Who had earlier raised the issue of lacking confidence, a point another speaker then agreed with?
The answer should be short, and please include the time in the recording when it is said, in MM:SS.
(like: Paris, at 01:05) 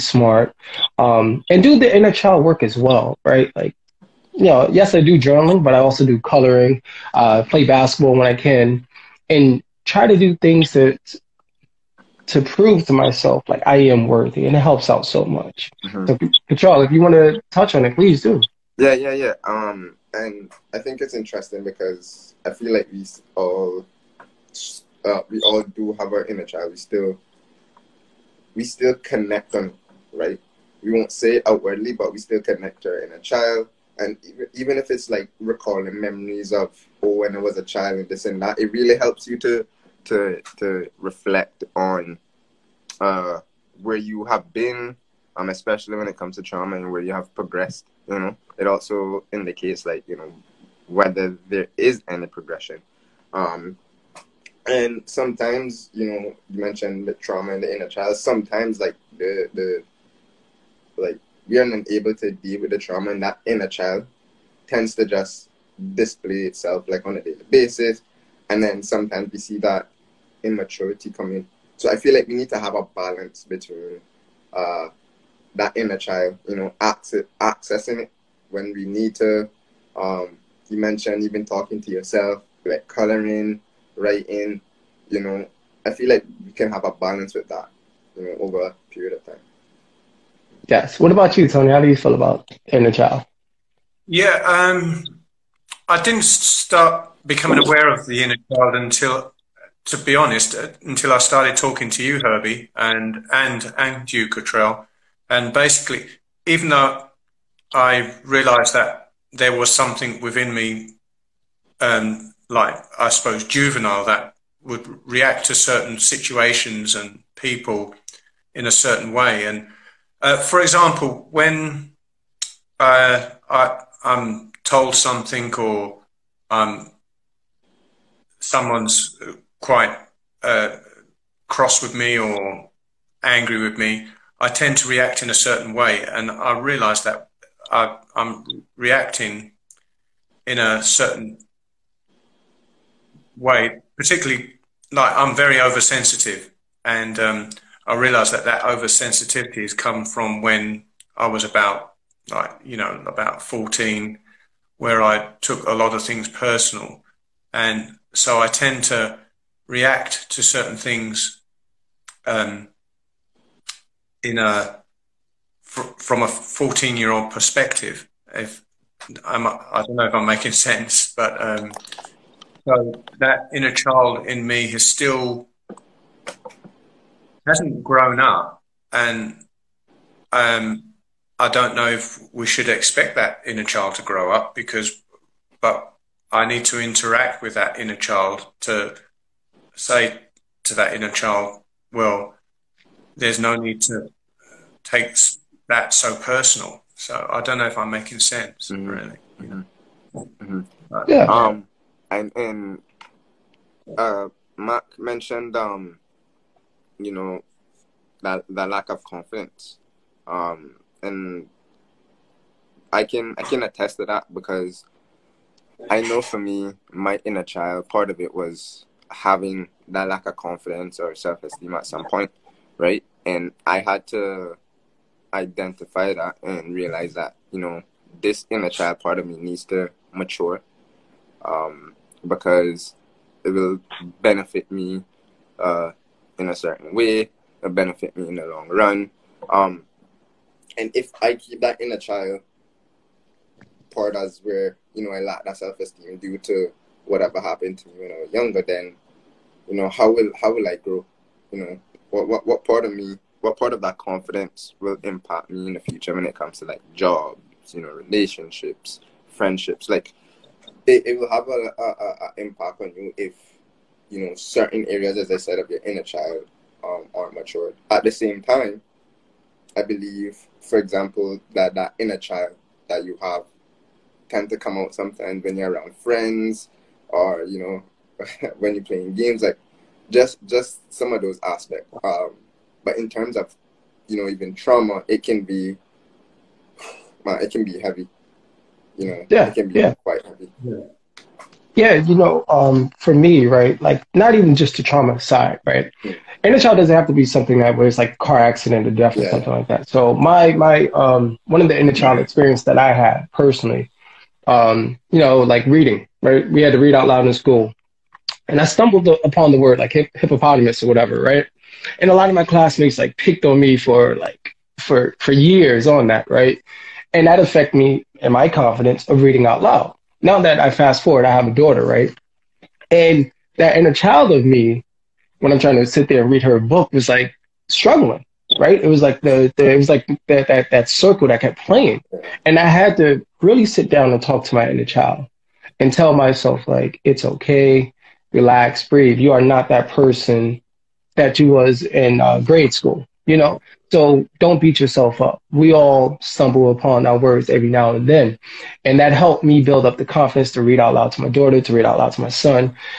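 Mark, at 03:24.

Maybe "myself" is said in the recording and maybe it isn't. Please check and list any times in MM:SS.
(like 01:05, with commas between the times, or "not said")
00:12, 05:36.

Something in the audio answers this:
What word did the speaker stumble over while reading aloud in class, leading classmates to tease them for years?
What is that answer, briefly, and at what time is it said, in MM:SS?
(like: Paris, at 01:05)
hippopotamus, at 05:10.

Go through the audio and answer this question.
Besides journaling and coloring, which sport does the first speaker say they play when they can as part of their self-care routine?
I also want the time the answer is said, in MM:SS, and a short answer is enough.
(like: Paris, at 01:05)
basketball, at 00:07.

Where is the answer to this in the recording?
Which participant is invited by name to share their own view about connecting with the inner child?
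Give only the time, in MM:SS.
01:31.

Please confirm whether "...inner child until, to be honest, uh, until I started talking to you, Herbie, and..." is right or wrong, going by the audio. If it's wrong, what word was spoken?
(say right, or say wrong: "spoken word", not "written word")
right.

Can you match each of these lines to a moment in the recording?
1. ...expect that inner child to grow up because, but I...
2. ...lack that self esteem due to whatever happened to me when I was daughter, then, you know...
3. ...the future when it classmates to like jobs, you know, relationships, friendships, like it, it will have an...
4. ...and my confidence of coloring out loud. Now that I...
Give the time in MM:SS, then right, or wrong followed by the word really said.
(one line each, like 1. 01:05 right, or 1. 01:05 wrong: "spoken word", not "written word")
1. 03:02 right
2. 04:05 wrong: "younger", not "daughter"
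3. 04:15 wrong: "comes", not "classmates"
4. 05:18 wrong: "reading", not "coloring".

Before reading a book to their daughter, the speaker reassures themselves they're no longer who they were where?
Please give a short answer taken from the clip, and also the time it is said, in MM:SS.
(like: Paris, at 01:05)
grade school, at 05:42.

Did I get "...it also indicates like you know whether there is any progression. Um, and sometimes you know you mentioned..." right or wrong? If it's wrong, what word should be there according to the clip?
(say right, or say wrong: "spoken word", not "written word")
right.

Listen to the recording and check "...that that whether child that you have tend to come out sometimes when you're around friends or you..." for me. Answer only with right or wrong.
wrong.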